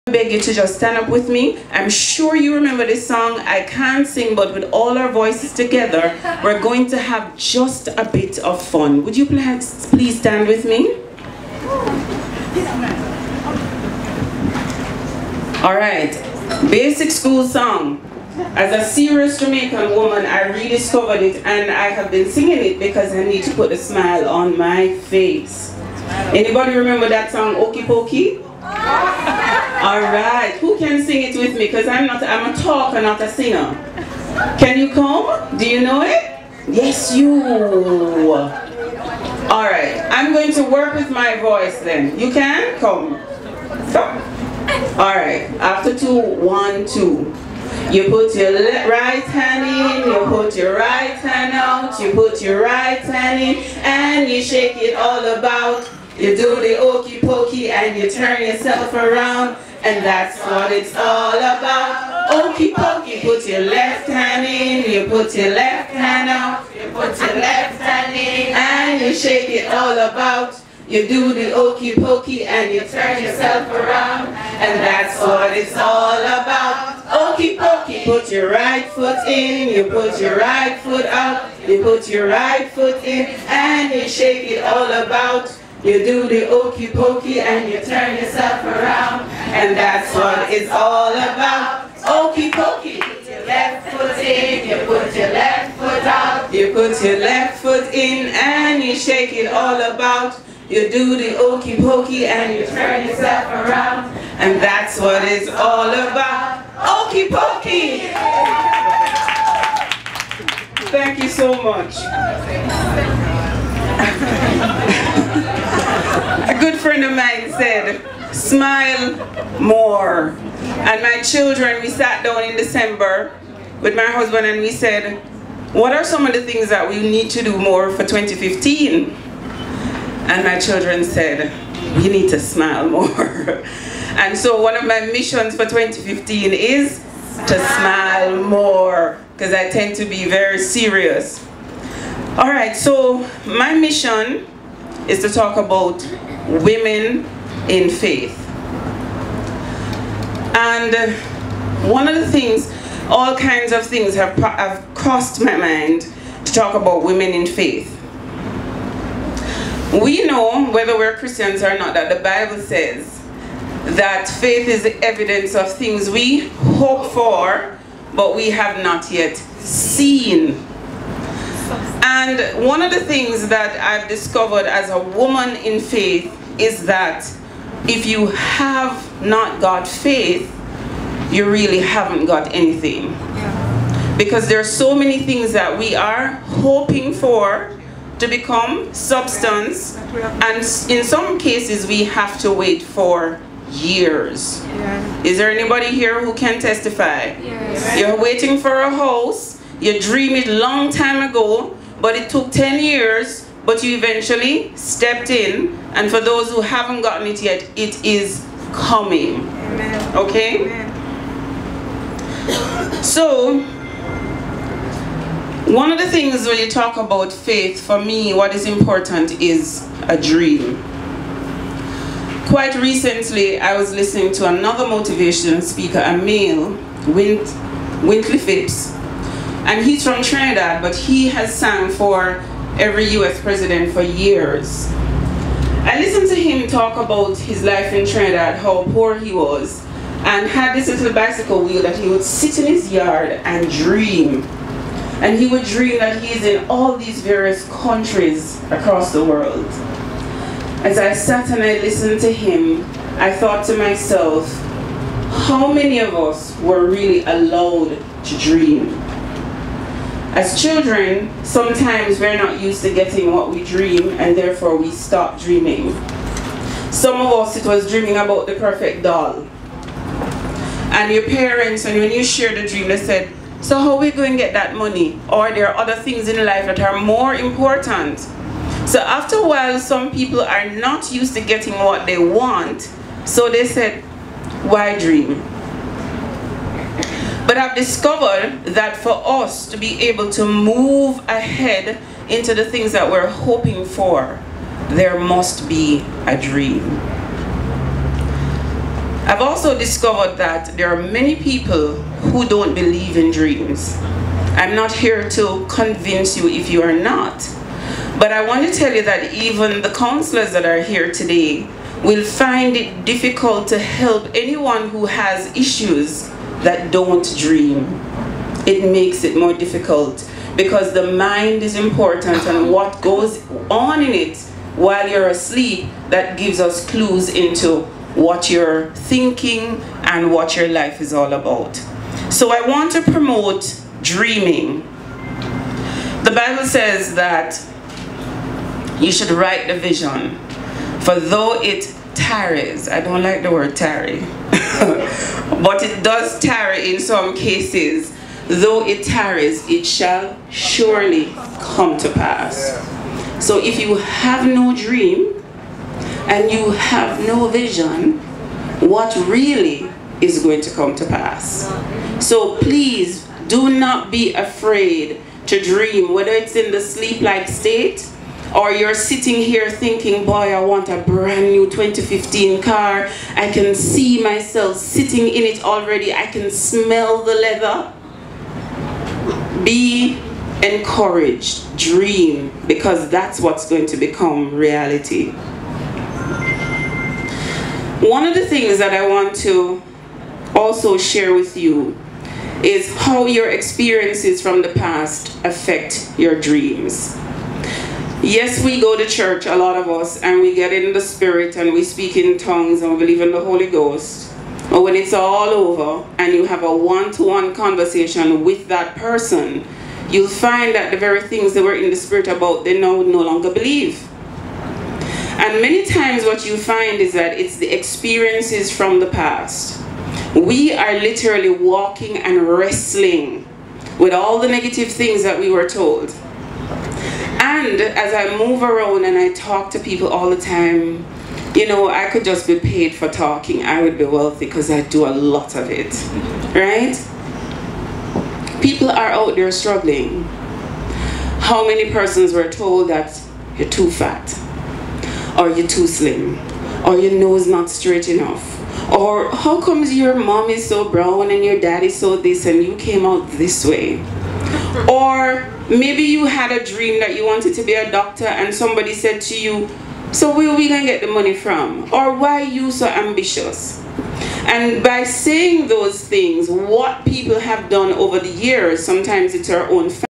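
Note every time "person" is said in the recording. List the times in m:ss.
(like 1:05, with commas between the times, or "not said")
6:48, 7:21.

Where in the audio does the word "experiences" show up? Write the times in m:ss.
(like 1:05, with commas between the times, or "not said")
6:33, 6:57.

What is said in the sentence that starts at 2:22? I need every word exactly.
All right, so my mission is to talk about women in faith.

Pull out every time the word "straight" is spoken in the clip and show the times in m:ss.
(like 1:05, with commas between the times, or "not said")
7:27.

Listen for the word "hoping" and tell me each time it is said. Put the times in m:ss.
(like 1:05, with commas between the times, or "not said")
3:06, 4:53.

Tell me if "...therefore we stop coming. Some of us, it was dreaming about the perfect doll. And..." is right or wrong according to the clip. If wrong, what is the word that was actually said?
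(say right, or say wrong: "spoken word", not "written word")
wrong: "dreaming", not "coming".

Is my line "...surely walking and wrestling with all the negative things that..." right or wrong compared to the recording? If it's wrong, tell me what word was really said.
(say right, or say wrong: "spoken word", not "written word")
wrong: "literally", not "surely".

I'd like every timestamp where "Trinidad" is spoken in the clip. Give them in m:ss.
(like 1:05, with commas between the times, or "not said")
3:50, 3:58.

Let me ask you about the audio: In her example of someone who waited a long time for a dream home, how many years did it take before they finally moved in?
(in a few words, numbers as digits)
10 years.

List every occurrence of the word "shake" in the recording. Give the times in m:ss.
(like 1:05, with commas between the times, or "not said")
0:54, 1:09, 1:24, 1:38.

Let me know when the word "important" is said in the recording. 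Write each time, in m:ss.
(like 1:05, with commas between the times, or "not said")
3:38, 4:37, 5:21.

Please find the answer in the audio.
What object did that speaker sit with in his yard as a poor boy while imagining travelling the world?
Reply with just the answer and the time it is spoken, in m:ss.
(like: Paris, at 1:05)
Bicycle wheel, at 4:01.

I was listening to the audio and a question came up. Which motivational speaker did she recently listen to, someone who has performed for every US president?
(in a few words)
Wintley Phipps.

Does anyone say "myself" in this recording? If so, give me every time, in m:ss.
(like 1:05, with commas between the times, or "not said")
4:13, 6:14.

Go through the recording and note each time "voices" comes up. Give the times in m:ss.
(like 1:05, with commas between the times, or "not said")
0:05, 0:41.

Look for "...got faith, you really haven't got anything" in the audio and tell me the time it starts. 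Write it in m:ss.
2:59.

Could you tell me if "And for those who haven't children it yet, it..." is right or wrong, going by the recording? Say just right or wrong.
wrong.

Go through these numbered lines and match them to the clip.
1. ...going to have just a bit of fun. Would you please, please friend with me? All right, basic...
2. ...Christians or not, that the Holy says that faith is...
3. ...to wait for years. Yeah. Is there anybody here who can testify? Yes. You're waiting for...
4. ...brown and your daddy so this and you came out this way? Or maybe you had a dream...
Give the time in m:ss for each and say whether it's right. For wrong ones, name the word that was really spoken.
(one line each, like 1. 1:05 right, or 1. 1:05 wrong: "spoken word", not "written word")
1. 0:06 wrong: "stand", not "friend"
2. 2:41 wrong: "Bible", not "Holy"
3. 3:12 right
4. 7:30 right.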